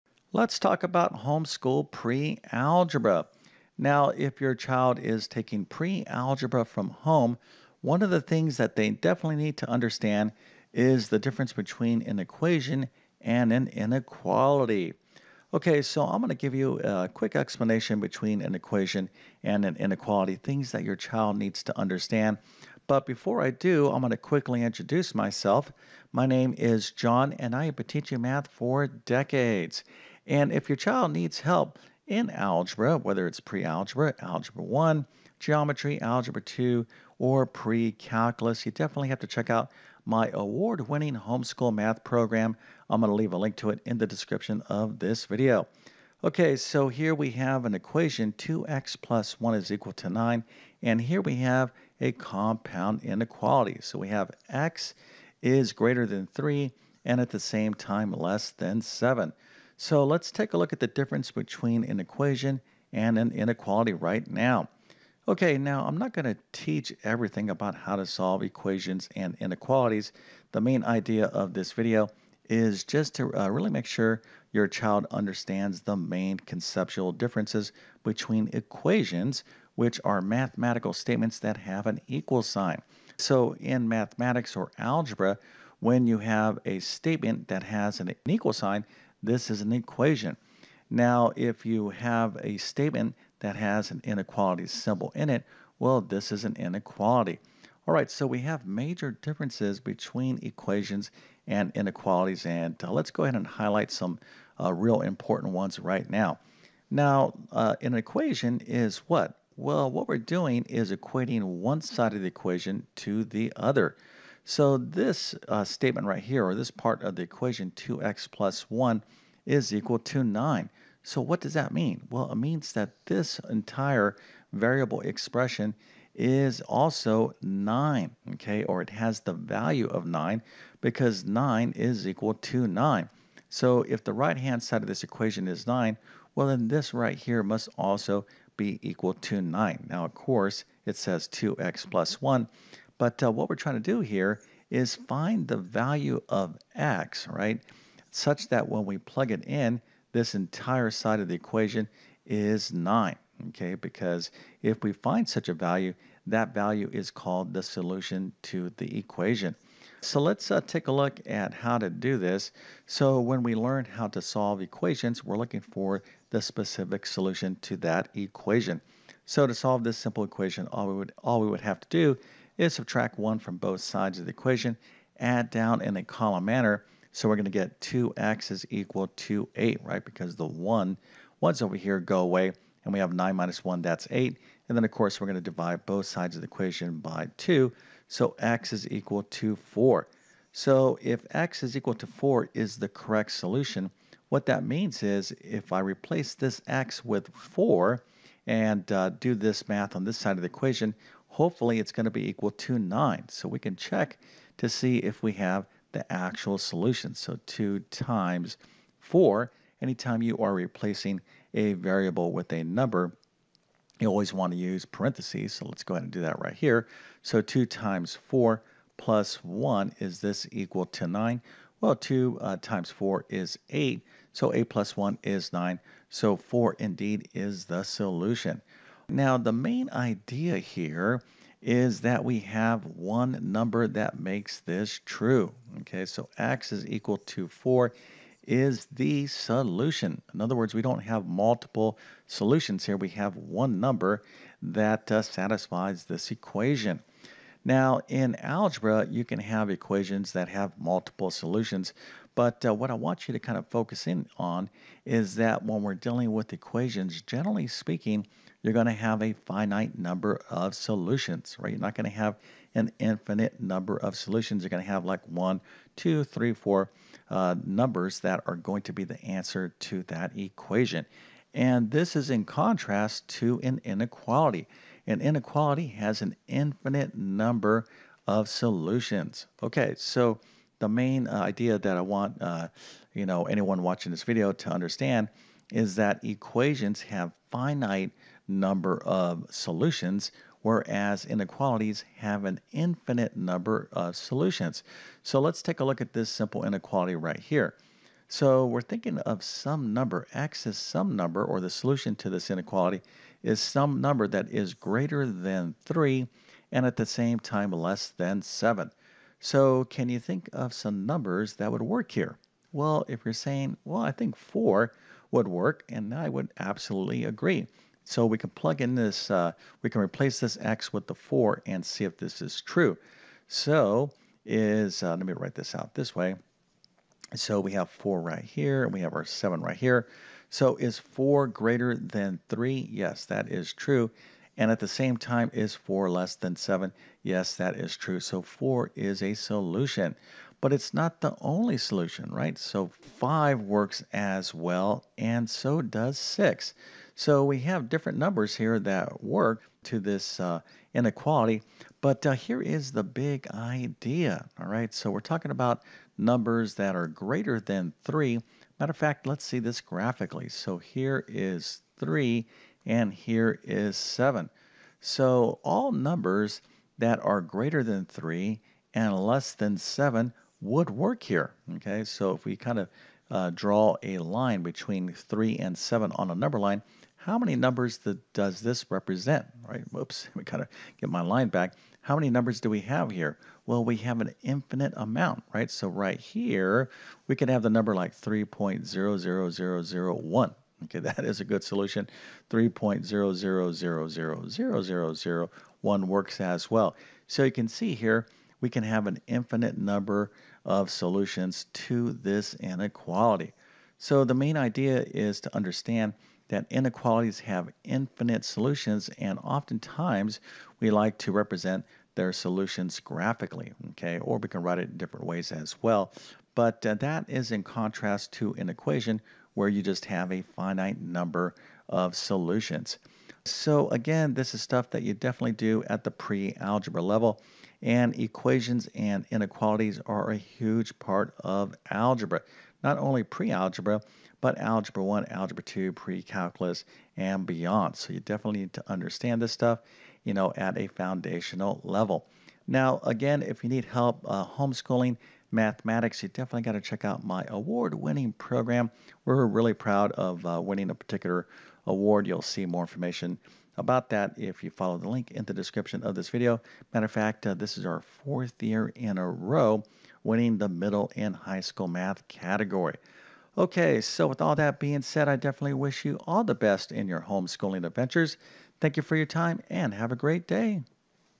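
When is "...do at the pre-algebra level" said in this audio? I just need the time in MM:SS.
07:05.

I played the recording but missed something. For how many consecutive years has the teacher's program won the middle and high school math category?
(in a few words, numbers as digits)
4.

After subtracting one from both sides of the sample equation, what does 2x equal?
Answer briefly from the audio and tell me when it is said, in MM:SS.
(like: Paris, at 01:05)
8, at 02:57.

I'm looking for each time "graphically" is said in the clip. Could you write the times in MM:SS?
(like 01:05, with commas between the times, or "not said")
05:59, 06:52.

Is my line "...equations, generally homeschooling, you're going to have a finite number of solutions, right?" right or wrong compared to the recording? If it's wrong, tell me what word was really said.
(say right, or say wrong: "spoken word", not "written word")
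wrong: "speaking", not "homeschooling".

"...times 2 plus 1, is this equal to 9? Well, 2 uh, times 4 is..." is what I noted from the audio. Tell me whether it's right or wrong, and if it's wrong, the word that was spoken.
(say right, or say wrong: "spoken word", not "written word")
wrong: "4", not "2".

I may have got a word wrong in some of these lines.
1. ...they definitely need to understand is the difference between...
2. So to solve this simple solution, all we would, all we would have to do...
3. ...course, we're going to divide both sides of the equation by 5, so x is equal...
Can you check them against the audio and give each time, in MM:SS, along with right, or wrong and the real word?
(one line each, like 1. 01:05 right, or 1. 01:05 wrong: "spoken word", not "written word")
1. 00:08 right
2. 02:49 wrong: "equation", not "solution"
3. 03:04 wrong: "2", not "5".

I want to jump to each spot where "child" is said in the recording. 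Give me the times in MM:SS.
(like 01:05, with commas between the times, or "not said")
00:04, 00:20, 00:30, 01:14.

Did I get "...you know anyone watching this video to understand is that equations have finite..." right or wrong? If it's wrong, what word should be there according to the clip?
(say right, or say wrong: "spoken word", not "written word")
right.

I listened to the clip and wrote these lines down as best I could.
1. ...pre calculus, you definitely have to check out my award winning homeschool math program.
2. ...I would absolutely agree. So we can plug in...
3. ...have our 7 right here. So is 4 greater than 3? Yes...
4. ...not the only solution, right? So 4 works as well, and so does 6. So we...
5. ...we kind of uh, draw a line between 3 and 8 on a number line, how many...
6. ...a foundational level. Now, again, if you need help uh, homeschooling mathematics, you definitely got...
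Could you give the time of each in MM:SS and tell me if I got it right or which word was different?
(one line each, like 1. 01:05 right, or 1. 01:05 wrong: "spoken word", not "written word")
1. 00:37 right
2. 05:16 right
3. 05:29 right
4. 05:40 wrong: "5", not "4"
5. 06:12 wrong: "7", not "8"
6. 07:20 right.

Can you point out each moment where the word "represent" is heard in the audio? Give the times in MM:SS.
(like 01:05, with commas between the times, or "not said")
06:18, 06:51.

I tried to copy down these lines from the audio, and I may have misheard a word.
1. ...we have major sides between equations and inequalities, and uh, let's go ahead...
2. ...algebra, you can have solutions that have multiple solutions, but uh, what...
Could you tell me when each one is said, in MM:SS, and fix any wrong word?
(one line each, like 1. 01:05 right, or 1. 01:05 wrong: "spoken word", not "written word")
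1. 01:38 wrong: "differences", not "sides"
2. 04:08 wrong: "equations", not "solutions".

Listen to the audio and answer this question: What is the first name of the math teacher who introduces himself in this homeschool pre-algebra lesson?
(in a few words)
John.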